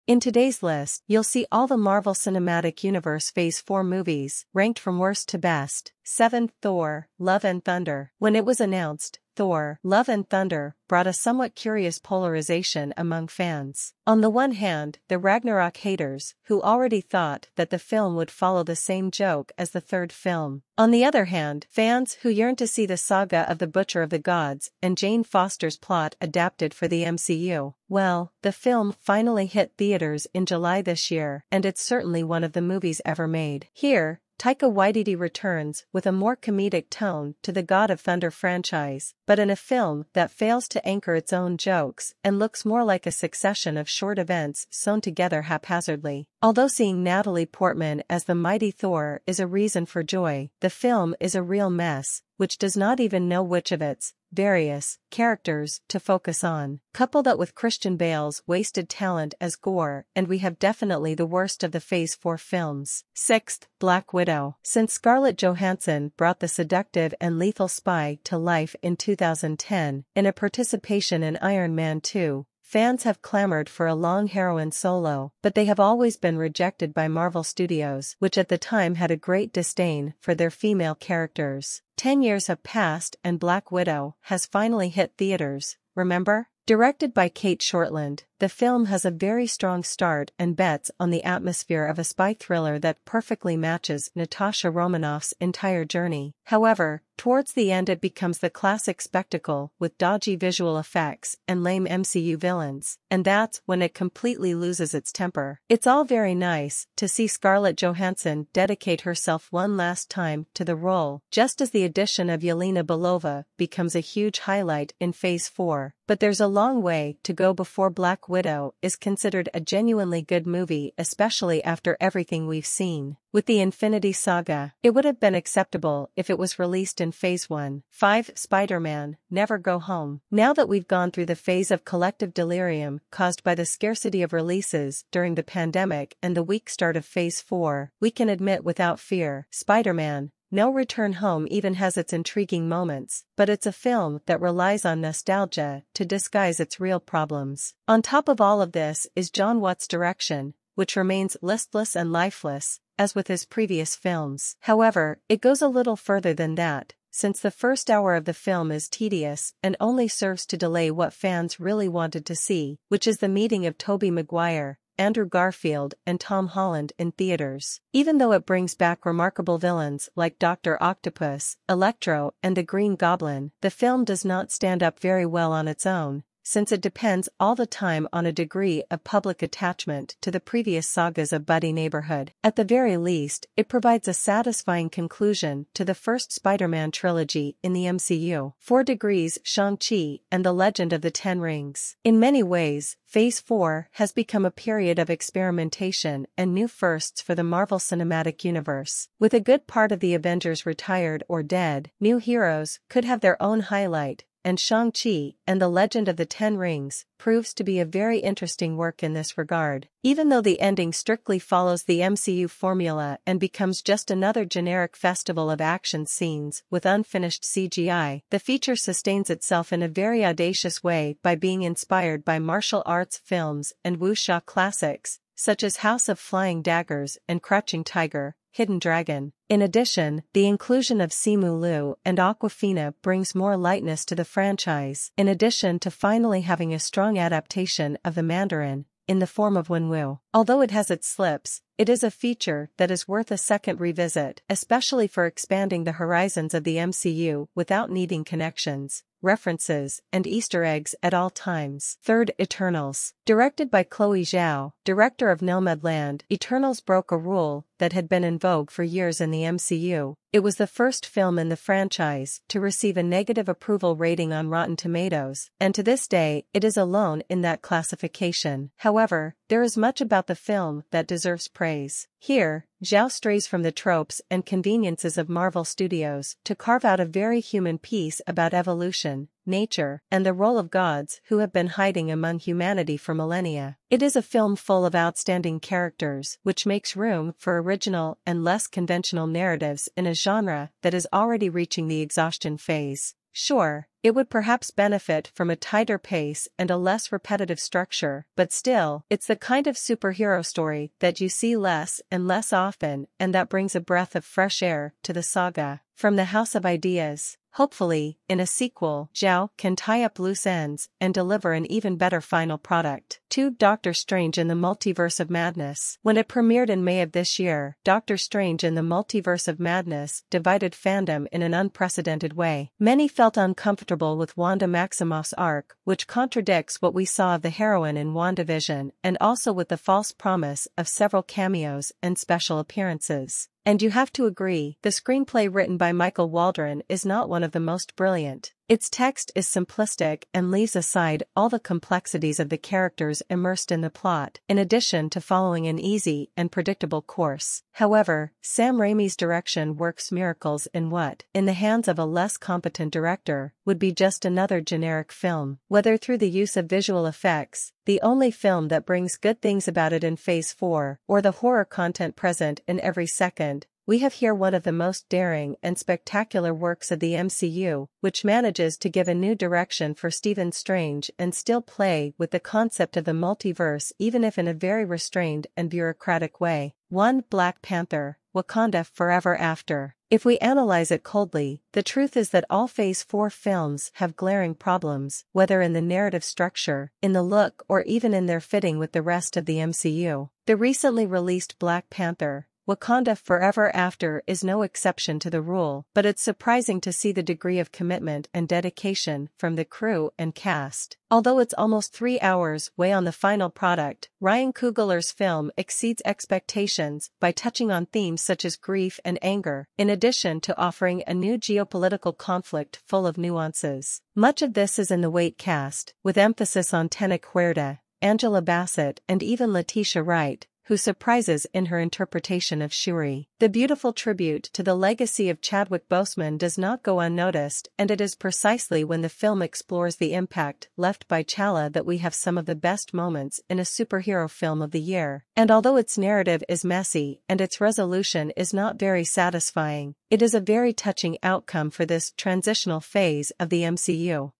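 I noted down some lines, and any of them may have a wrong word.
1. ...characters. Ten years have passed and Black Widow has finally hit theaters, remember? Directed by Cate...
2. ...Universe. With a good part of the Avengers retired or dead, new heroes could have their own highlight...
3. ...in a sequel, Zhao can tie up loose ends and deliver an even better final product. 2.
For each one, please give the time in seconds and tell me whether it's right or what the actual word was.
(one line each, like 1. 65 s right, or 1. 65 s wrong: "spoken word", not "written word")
1. 80 s right
2. 198 s right
3. 308 s right.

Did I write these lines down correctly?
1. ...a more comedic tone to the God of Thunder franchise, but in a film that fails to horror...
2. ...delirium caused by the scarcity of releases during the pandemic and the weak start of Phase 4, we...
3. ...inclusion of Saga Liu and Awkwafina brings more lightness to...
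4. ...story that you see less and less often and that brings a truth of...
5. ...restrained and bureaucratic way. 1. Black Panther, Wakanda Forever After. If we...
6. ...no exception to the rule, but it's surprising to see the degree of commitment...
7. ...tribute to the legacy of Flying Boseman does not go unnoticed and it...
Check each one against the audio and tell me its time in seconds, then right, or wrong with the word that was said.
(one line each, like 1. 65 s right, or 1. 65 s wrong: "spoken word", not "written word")
1. 36 s wrong: "anchor", not "horror"
2. 132 s right
3. 230 s wrong: "Simu", not "Saga"
4. 300 s wrong: "breath", not "truth"
5. 374 s right
6. 394 s right
7. 423 s wrong: "Chadwick", not "Flying".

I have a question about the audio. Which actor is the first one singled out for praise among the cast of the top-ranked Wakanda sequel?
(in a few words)
Tenoch Huerta.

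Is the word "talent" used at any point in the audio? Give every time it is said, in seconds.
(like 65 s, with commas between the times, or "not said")
58 s.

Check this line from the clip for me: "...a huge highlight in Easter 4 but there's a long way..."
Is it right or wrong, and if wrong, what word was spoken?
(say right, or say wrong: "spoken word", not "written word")
wrong: "Phase", not "Easter".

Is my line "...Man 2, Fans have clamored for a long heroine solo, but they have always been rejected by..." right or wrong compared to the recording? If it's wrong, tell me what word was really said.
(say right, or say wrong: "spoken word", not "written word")
right.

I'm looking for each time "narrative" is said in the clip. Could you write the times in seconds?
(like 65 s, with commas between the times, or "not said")
289 s, 385 s, 435 s.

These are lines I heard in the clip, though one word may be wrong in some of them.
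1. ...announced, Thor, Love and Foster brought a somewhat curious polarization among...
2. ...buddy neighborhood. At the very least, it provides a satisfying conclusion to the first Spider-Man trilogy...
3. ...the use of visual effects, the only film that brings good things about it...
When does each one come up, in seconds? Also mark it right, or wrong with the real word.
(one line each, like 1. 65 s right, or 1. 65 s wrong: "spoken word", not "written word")
1. 8 s wrong: "Thunder", not "Foster"
2. 181 s right
3. 356 s right.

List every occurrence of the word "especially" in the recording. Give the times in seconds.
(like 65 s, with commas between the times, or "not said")
120 s, 244 s.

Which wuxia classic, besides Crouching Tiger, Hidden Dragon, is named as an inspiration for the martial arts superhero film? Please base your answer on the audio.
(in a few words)
House of Flying Daggers.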